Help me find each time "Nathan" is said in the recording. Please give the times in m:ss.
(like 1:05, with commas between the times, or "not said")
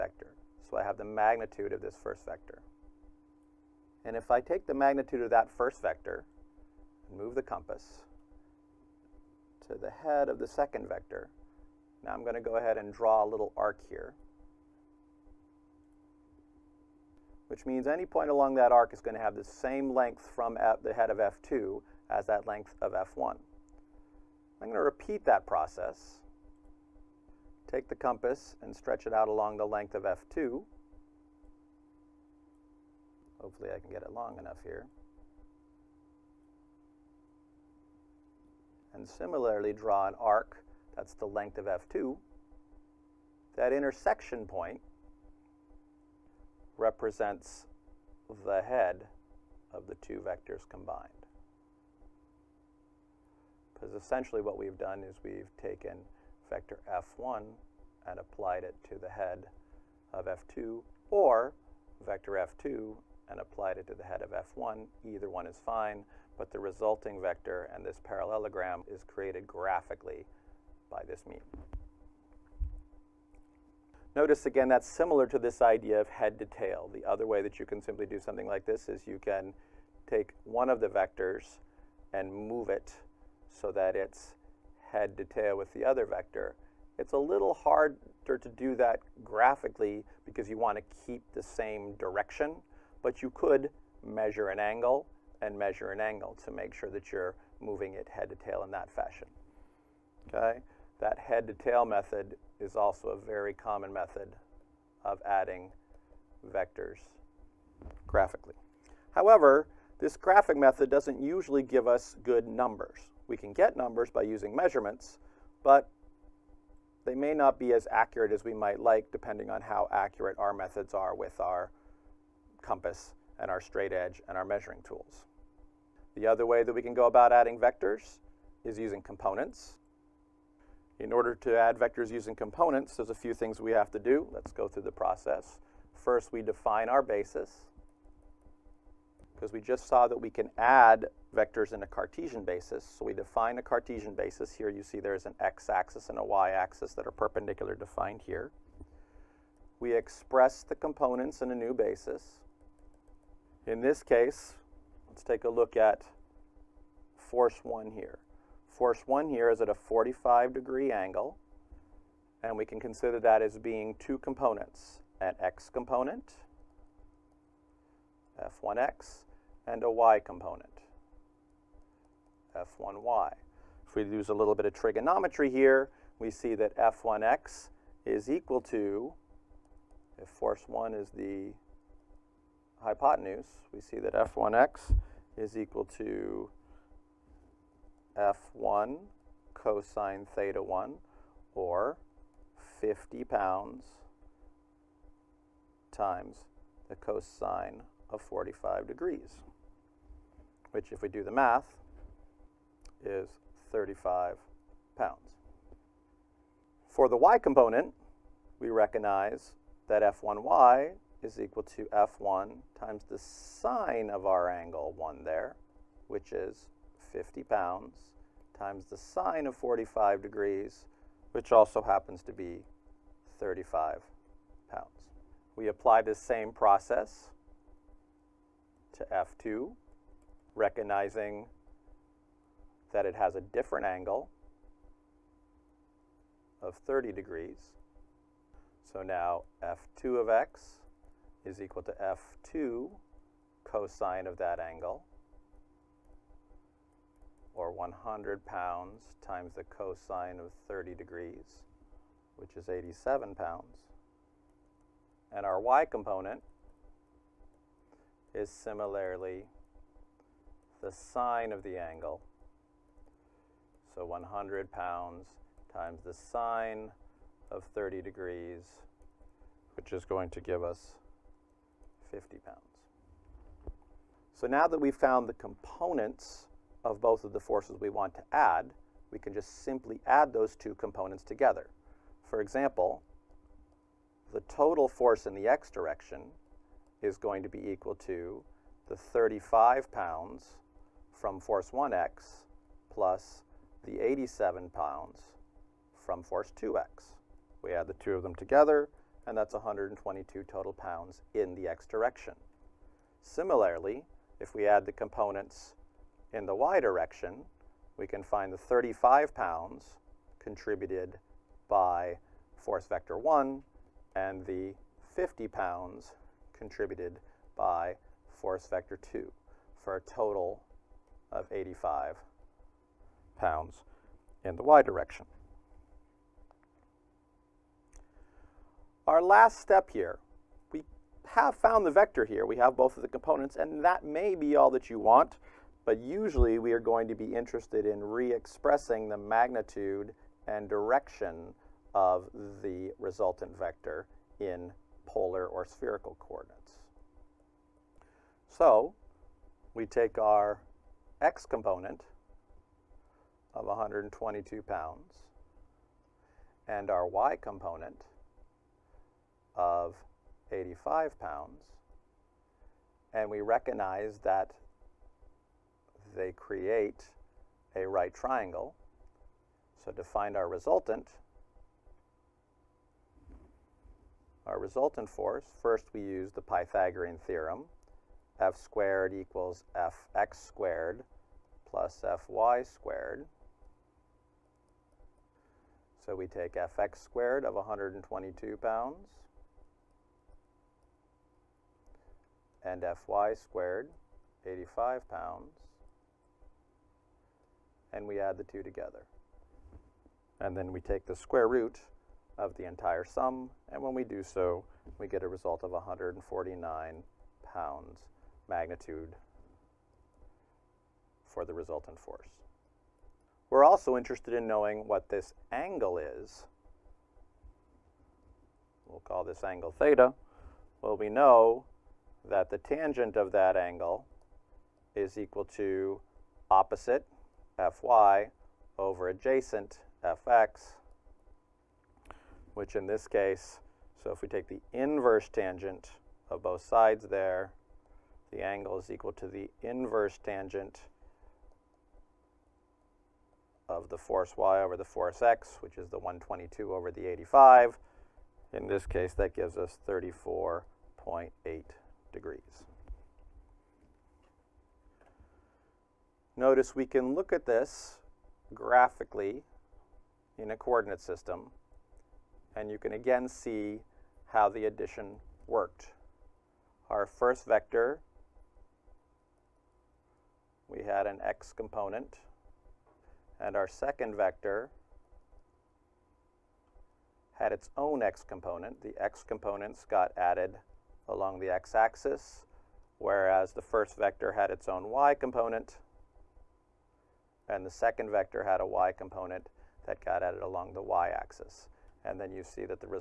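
not said.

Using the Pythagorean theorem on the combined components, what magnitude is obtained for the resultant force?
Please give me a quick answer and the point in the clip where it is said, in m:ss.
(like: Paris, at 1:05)
149 pounds, at 6:45.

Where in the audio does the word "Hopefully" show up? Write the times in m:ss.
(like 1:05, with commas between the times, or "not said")
0:33.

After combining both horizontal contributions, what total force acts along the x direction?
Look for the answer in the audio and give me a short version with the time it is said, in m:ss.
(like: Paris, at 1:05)
122 pounds, at 4:59.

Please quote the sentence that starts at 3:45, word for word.
We apply this same process to F2, recognizing that it has a different angle of 30 degrees.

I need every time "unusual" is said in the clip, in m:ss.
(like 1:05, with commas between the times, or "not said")
not said.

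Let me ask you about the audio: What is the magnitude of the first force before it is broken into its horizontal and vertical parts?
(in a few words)
50 pounds.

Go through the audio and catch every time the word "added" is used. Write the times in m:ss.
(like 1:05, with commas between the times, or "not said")
8:00, 8:10.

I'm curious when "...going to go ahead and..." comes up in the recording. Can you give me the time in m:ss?
0:12.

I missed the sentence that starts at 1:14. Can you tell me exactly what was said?
Notice again, that's similar to this idea of head to tail.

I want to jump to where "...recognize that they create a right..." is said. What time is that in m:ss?
6:03.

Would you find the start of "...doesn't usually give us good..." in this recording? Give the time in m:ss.
1:50.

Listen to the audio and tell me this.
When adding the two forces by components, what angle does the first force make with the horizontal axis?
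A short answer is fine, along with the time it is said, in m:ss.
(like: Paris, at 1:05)
45 degrees, at 2:39.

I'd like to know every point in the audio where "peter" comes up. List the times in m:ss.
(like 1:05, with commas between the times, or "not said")
not said.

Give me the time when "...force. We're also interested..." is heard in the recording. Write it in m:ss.
6:51.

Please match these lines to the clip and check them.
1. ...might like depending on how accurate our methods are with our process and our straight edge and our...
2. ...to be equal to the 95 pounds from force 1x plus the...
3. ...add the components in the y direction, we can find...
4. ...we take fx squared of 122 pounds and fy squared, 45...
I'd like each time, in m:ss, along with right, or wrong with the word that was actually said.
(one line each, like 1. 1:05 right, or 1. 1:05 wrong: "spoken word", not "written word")
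1. 1:58 wrong: "compass", not "process"
2. 4:47 wrong: "35", not "95"
3. 5:04 right
4. 6:26 wrong: "85", not "45".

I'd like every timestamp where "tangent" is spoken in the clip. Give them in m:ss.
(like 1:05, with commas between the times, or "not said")
7:02, 7:15, 7:20.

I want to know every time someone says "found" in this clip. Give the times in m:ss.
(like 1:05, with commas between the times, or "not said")
4:34, 5:31.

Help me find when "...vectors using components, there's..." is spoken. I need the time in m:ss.
2:11.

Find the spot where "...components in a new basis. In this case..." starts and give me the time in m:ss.
2:30.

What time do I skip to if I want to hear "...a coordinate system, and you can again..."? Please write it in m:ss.
7:40.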